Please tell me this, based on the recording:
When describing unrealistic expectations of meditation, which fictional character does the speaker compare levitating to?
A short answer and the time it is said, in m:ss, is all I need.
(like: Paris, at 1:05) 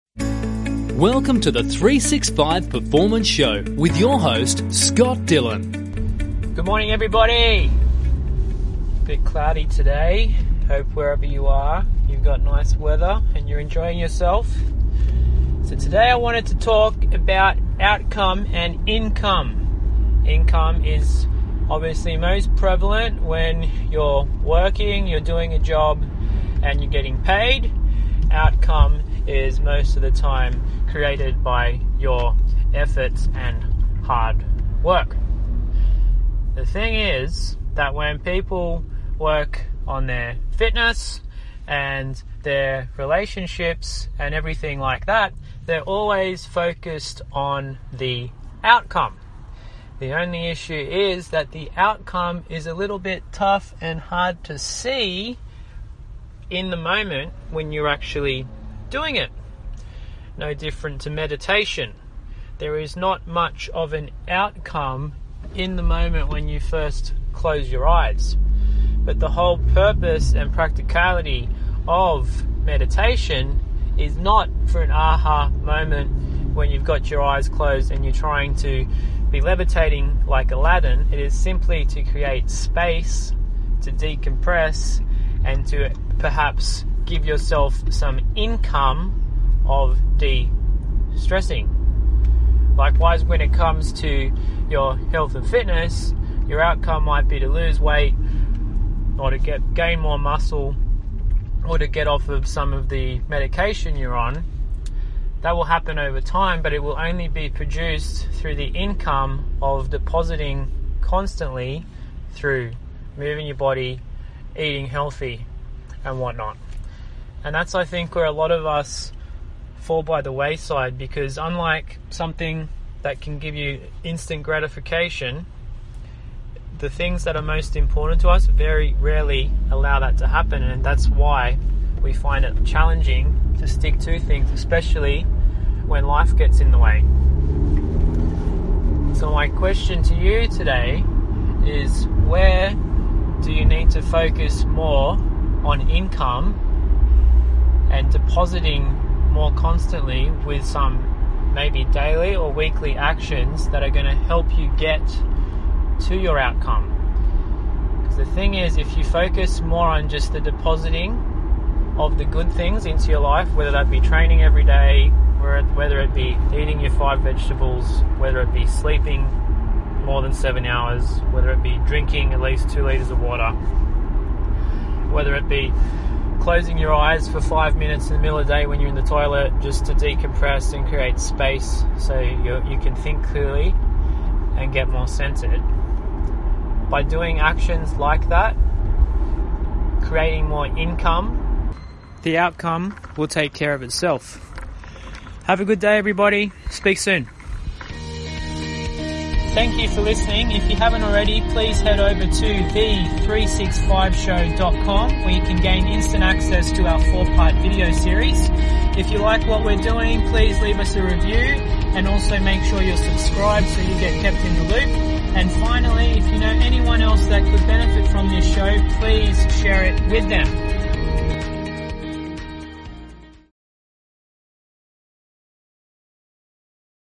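Aladdin, at 1:20.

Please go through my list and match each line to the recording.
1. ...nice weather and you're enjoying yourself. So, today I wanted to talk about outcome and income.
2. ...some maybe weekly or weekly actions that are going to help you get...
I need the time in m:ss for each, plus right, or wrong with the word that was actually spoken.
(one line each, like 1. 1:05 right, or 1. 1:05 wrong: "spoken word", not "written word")
1. 0:12 right
2. 2:30 wrong: "daily", not "weekly".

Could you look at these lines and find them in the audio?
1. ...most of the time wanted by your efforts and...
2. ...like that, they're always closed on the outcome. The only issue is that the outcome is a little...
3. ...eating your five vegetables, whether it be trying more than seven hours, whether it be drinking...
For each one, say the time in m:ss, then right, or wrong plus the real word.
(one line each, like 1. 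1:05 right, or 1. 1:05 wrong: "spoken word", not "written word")
1. 0:29 wrong: "created", not "wanted"
2. 0:44 wrong: "focused", not "closed"
3. 2:46 wrong: "sleeping", not "trying".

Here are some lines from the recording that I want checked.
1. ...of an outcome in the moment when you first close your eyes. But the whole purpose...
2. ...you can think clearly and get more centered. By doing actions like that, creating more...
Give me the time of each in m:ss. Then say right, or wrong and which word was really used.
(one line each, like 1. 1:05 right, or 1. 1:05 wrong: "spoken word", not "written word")
1. 1:03 right
2. 3:02 right.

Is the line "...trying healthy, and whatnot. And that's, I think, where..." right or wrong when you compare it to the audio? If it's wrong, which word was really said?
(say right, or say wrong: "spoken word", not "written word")
wrong: "eating", not "trying".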